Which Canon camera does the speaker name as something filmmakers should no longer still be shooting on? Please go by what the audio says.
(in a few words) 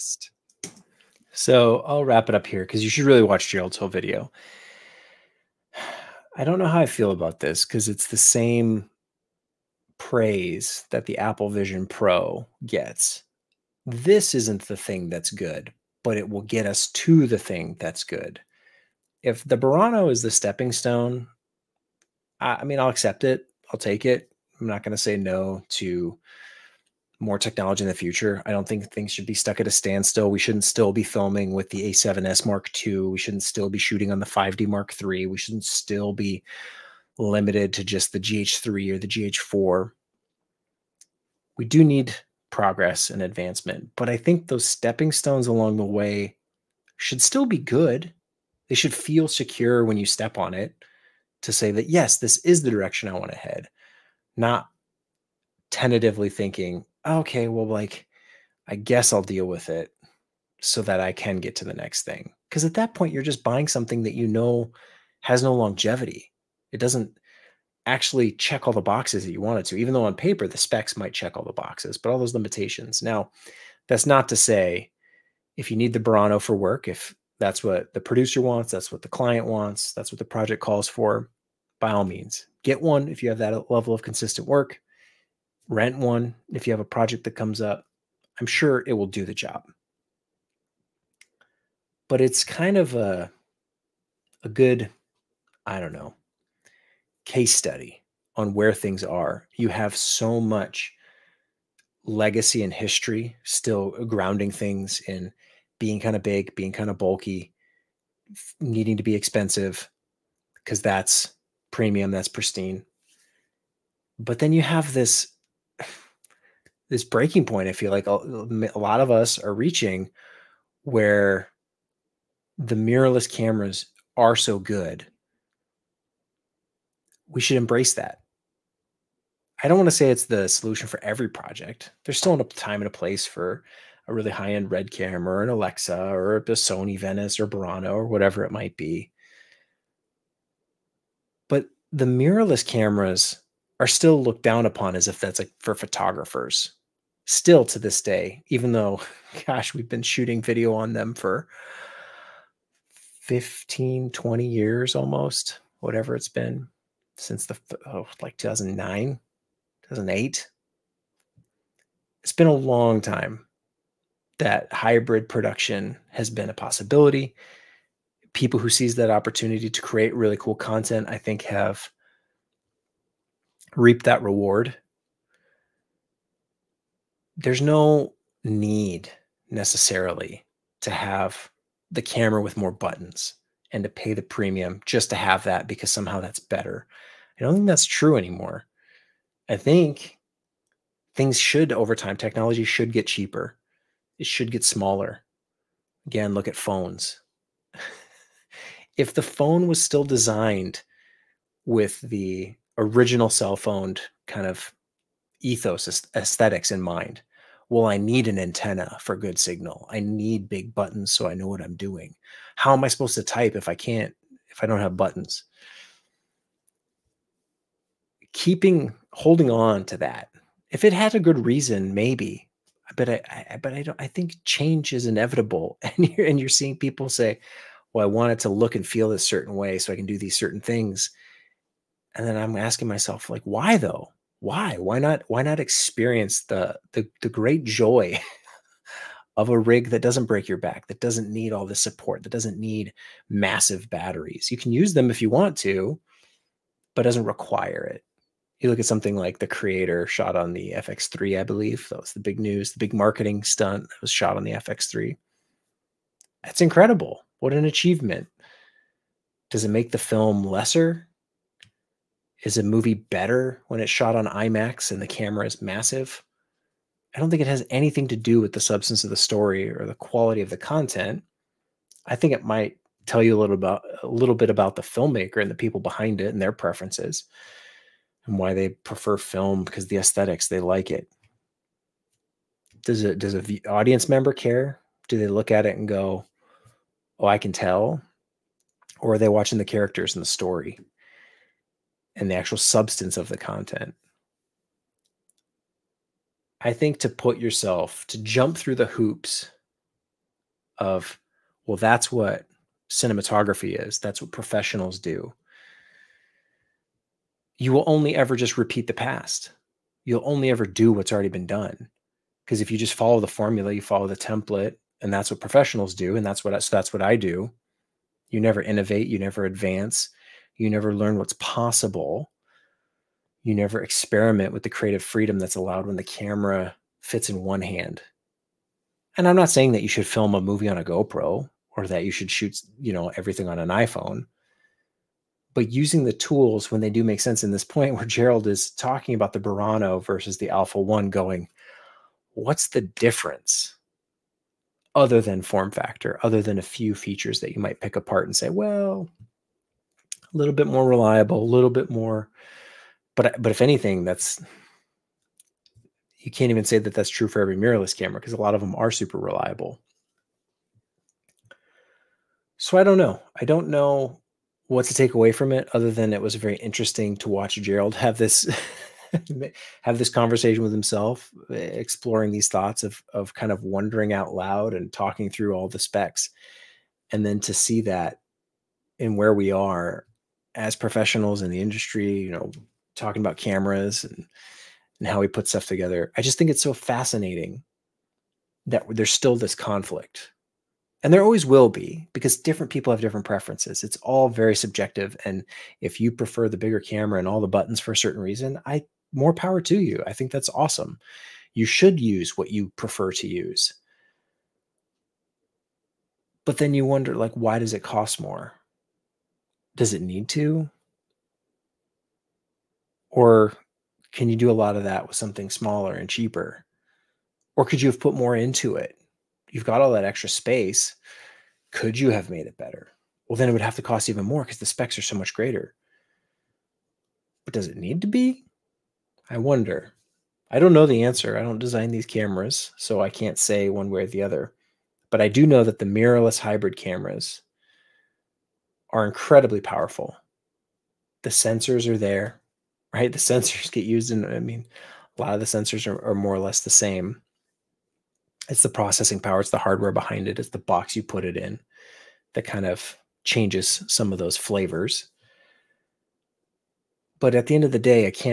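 5D Mark III.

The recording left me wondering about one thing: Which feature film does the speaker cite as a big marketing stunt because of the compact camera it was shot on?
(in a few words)
The Creator.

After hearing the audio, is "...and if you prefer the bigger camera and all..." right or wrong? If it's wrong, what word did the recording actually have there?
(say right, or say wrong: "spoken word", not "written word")
right.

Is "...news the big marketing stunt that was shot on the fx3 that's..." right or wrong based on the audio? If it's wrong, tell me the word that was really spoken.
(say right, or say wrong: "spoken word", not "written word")
right.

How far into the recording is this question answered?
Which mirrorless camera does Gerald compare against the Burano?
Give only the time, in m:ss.
5:40.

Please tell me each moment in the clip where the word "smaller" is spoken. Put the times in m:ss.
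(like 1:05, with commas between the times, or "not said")
3:14, 6:55.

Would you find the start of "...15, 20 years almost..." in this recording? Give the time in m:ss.
2:33.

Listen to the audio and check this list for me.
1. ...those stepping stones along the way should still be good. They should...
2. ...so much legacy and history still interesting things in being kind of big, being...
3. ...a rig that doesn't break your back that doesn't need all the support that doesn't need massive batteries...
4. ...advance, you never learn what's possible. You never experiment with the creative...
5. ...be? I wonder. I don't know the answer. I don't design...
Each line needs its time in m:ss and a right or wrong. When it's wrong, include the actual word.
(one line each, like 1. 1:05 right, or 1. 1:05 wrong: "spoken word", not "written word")
1. 0:44 right
2. 1:39 wrong: "grounding", not "interesting"
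3. 3:59 right
4. 5:19 right
5. 7:08 right.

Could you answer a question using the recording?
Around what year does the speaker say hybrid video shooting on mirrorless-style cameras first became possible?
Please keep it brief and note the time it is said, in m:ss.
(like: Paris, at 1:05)
2009, at 2:38.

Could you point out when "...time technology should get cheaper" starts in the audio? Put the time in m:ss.
3:11.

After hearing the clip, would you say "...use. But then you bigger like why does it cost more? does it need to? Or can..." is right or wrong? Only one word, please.
wrong.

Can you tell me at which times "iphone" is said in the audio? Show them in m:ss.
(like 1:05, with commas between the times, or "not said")
5:33.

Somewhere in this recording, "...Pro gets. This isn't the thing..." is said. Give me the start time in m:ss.
0:11.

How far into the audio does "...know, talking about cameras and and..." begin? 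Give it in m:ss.
6:22.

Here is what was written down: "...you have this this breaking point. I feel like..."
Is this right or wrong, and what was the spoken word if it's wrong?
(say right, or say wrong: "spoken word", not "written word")
right.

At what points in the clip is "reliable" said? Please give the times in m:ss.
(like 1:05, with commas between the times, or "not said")
5:50, 5:59.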